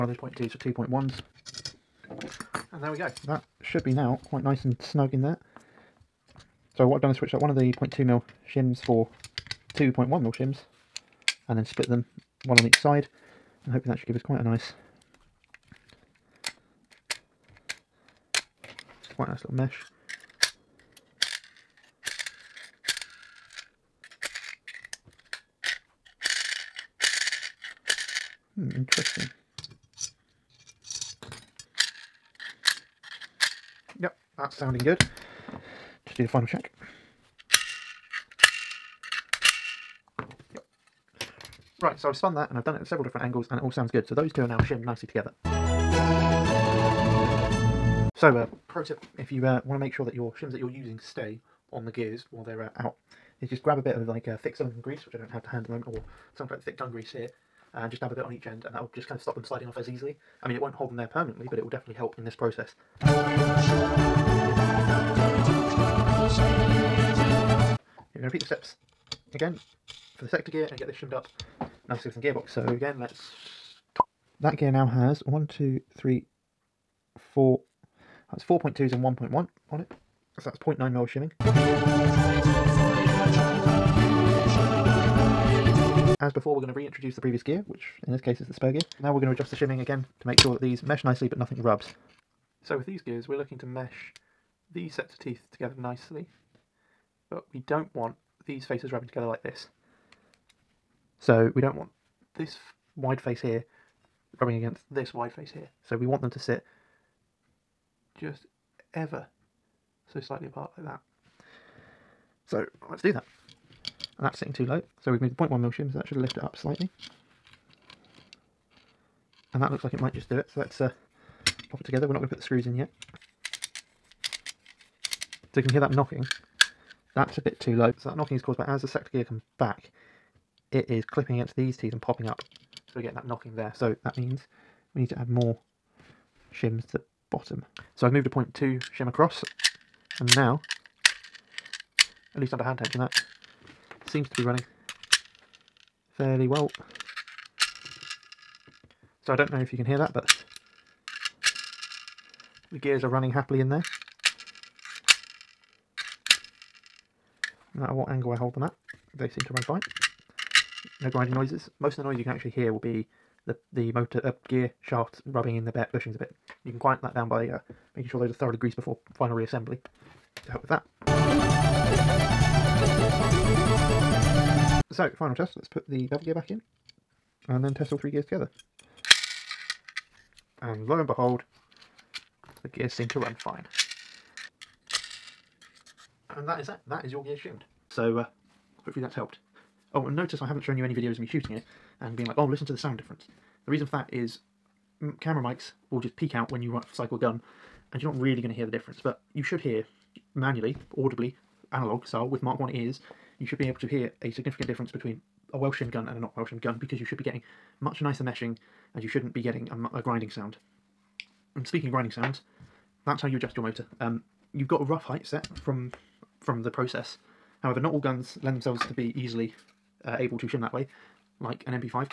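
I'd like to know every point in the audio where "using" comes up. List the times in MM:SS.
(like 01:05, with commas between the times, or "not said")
00:50.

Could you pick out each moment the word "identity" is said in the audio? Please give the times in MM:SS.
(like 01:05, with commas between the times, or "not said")
not said.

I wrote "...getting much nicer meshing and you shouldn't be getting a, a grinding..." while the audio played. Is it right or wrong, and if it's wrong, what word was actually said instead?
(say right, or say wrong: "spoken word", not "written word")
right.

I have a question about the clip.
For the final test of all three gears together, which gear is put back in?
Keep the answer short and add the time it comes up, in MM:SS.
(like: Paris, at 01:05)
bevel gear, at 02:56.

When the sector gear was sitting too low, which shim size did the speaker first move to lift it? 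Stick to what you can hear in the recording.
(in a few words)
0.1 mm.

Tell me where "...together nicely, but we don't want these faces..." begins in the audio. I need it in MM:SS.
01:35.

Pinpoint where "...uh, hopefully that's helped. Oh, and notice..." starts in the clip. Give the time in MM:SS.
03:08.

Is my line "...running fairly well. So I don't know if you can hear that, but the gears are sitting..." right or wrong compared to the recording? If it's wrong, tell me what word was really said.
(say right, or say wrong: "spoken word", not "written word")
wrong: "running", not "sitting".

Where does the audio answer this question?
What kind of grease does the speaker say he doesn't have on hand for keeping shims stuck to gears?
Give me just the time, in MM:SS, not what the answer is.
00:54.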